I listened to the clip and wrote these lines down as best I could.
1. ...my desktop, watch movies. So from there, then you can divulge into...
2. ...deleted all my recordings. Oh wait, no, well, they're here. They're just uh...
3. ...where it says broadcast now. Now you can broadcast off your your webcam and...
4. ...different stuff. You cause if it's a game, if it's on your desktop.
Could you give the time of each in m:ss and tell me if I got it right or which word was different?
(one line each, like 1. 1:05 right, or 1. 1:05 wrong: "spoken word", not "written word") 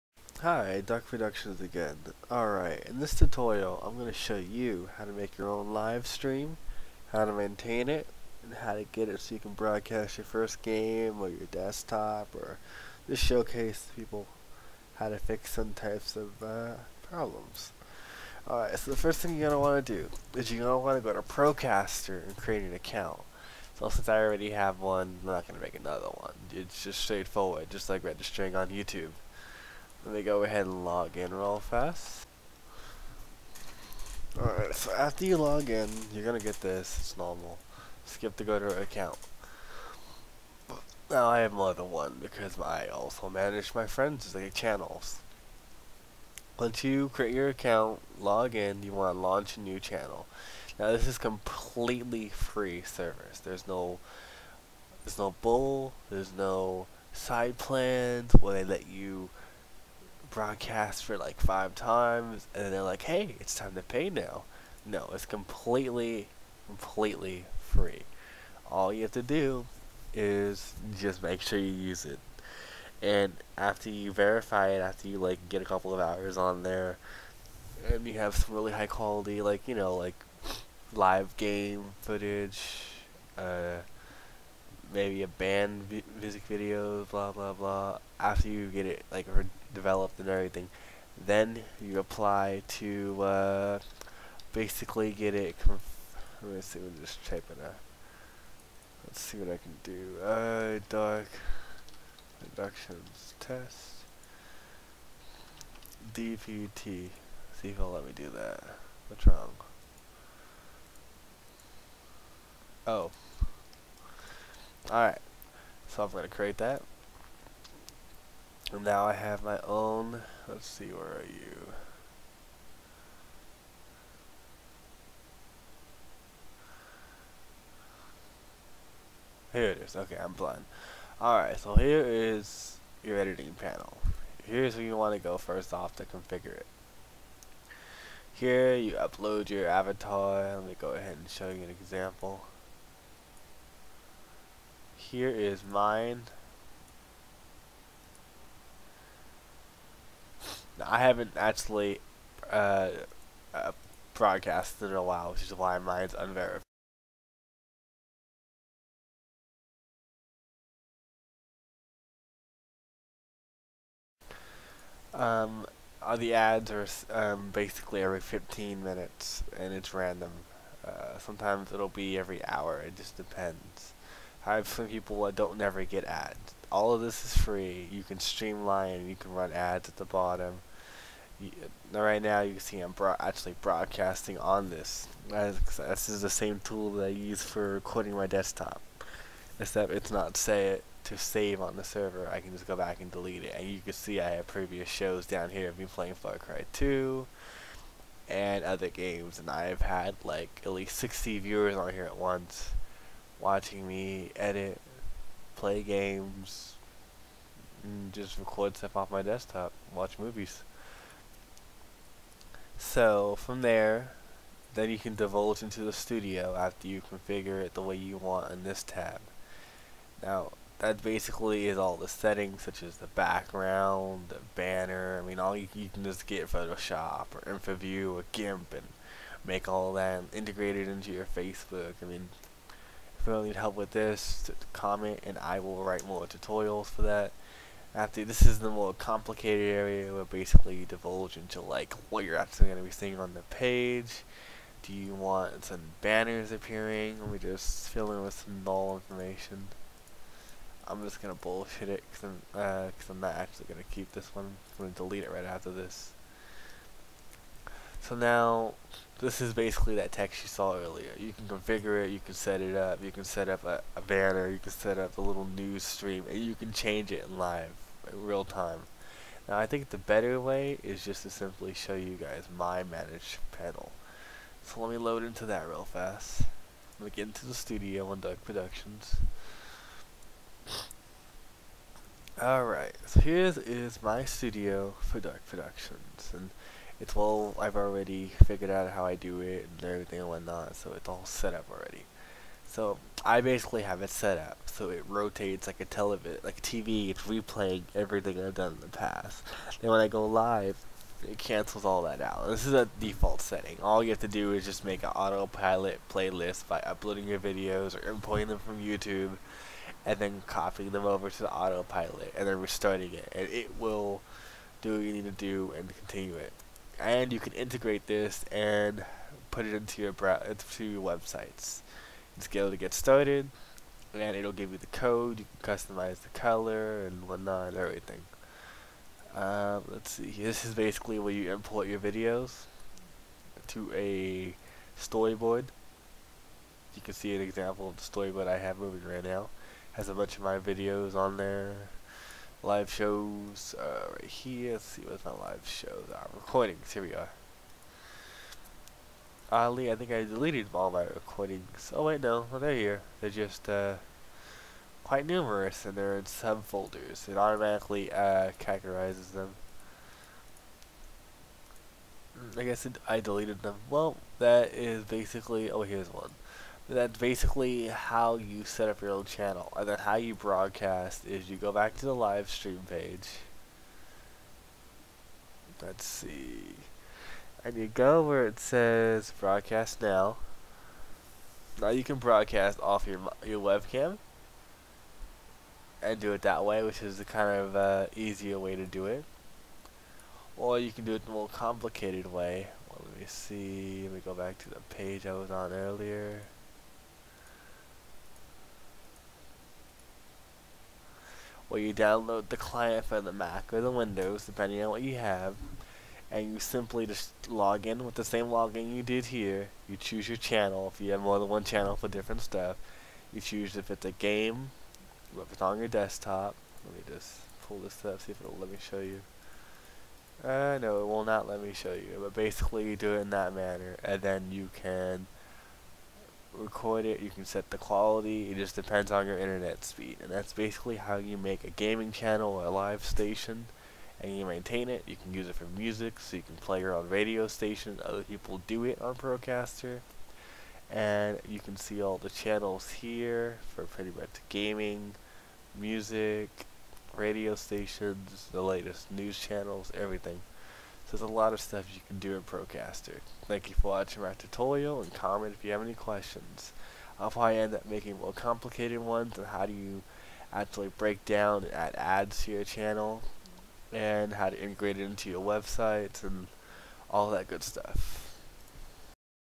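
1. 3:29 right
2. 5:50 right
3. 6:18 right
4. 6:52 wrong: "choose", not "cause".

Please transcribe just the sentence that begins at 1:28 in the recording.
After you get it like developed and everything, then you apply to uh, basically get it.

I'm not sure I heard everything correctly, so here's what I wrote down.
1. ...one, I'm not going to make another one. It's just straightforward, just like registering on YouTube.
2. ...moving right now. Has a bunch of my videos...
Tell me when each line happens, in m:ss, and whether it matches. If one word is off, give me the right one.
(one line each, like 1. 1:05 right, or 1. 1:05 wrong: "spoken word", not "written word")
1. 0:24 right
2. 5:38 right.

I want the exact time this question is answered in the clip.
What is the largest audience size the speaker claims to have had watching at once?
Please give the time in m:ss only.
3:20.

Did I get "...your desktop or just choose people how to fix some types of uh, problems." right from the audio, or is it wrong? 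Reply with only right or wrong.
wrong.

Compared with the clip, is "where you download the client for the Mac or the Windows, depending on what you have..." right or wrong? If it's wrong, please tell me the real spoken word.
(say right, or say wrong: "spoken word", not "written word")
right.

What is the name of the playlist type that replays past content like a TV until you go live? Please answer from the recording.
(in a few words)
autopilot playlist.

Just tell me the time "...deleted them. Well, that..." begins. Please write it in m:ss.
6:03.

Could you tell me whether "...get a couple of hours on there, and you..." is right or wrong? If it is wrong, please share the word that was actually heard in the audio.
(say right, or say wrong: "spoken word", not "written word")
right.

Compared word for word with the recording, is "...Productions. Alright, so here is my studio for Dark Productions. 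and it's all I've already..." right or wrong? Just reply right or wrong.
right.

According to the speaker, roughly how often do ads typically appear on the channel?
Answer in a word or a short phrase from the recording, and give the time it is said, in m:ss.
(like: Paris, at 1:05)
every 15 minutes, at 2:48.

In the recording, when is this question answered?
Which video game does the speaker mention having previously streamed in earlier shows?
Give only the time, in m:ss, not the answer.
3:16.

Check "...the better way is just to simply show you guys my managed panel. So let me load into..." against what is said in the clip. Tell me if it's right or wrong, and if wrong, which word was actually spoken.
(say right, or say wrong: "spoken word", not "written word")
right.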